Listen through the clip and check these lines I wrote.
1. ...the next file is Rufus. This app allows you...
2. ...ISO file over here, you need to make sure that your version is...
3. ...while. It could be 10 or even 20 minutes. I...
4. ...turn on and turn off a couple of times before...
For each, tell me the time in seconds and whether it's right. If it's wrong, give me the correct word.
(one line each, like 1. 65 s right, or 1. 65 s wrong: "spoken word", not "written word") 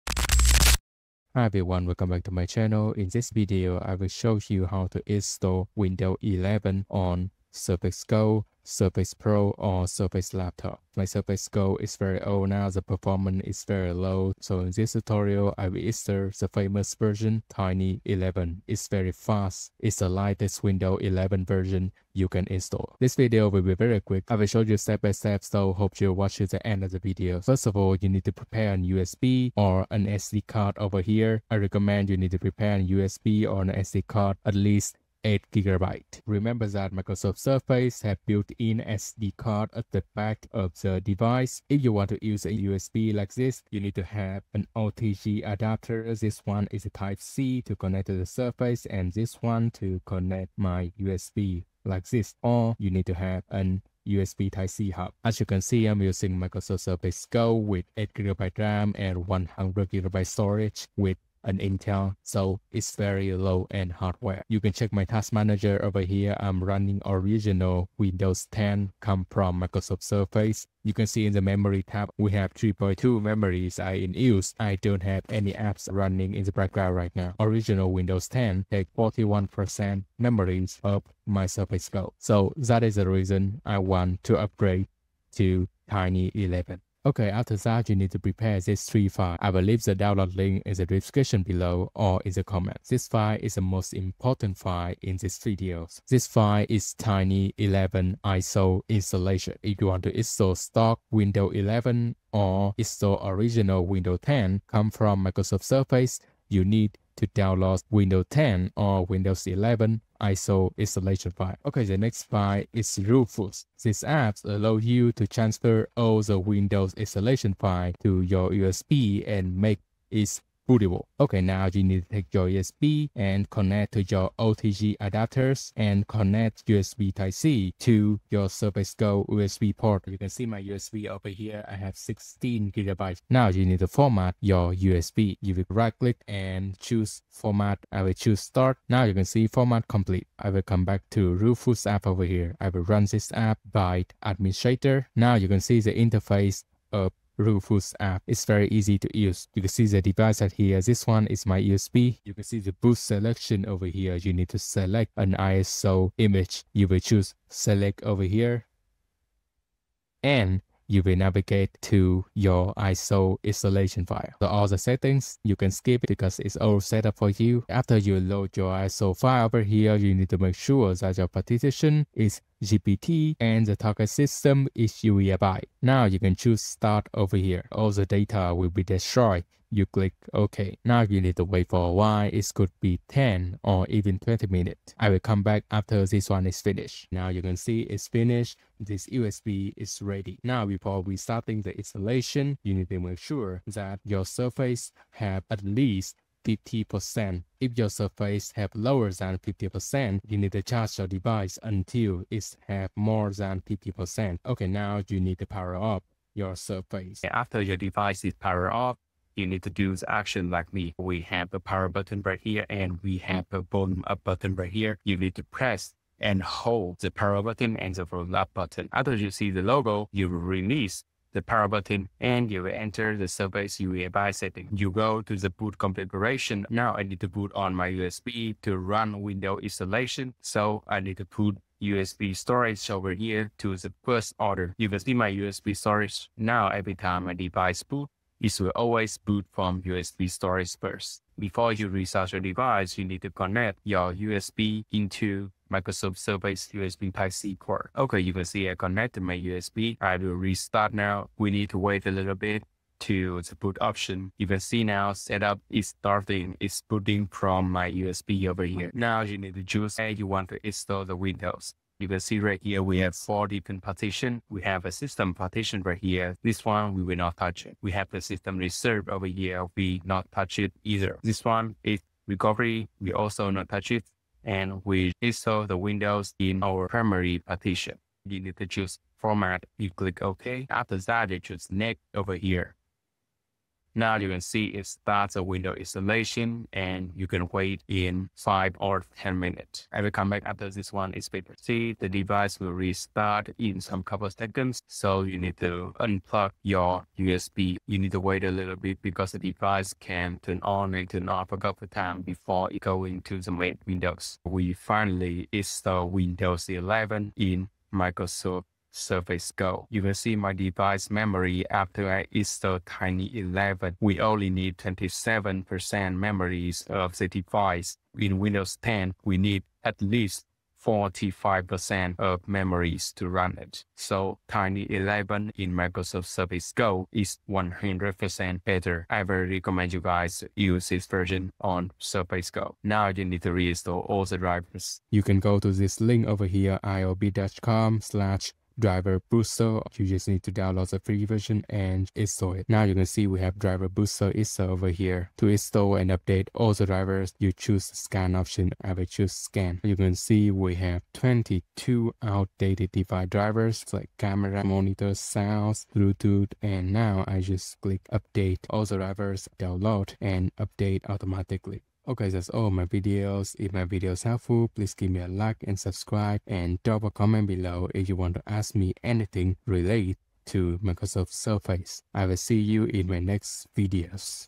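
1. 111 s right
2. 168 s wrong: "partition", not "version"
3. 181 s right
4. 300 s right.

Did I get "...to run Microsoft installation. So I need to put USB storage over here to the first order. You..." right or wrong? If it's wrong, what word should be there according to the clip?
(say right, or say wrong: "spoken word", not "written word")
wrong: "Windows", not "Microsoft".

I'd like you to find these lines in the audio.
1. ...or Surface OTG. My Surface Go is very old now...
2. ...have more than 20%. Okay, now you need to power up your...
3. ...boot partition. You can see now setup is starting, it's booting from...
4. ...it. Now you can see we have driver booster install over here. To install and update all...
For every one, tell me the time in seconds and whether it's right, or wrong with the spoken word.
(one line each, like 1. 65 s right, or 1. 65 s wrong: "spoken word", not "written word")
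1. 9 s wrong: "Laptop", not "OTG"
2. 202 s wrong: "50", not "20"
3. 253 s wrong: "option", not "partition"
4. 342 s right.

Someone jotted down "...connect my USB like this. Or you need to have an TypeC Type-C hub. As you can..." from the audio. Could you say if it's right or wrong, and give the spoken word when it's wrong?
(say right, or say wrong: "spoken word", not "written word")
wrong: "USB", not "TypeC".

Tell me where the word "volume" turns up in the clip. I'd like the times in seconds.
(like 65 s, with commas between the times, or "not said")
213 s, 218 s.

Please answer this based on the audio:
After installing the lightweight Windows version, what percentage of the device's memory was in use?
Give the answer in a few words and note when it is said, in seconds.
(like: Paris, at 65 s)
27%, at 314 s.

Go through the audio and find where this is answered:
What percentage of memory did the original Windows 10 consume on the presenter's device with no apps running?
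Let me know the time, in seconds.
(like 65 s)
78 s.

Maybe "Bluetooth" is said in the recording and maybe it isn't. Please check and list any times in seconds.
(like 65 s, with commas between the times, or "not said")
355 s.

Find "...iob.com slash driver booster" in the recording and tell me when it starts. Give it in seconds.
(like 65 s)
336 s.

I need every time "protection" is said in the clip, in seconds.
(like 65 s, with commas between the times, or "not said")
not said.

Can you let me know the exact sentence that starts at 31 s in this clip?
I recommend you need to prepare an USB or an SD card at least 8GB.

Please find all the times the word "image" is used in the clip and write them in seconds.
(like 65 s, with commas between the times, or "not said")
156 s.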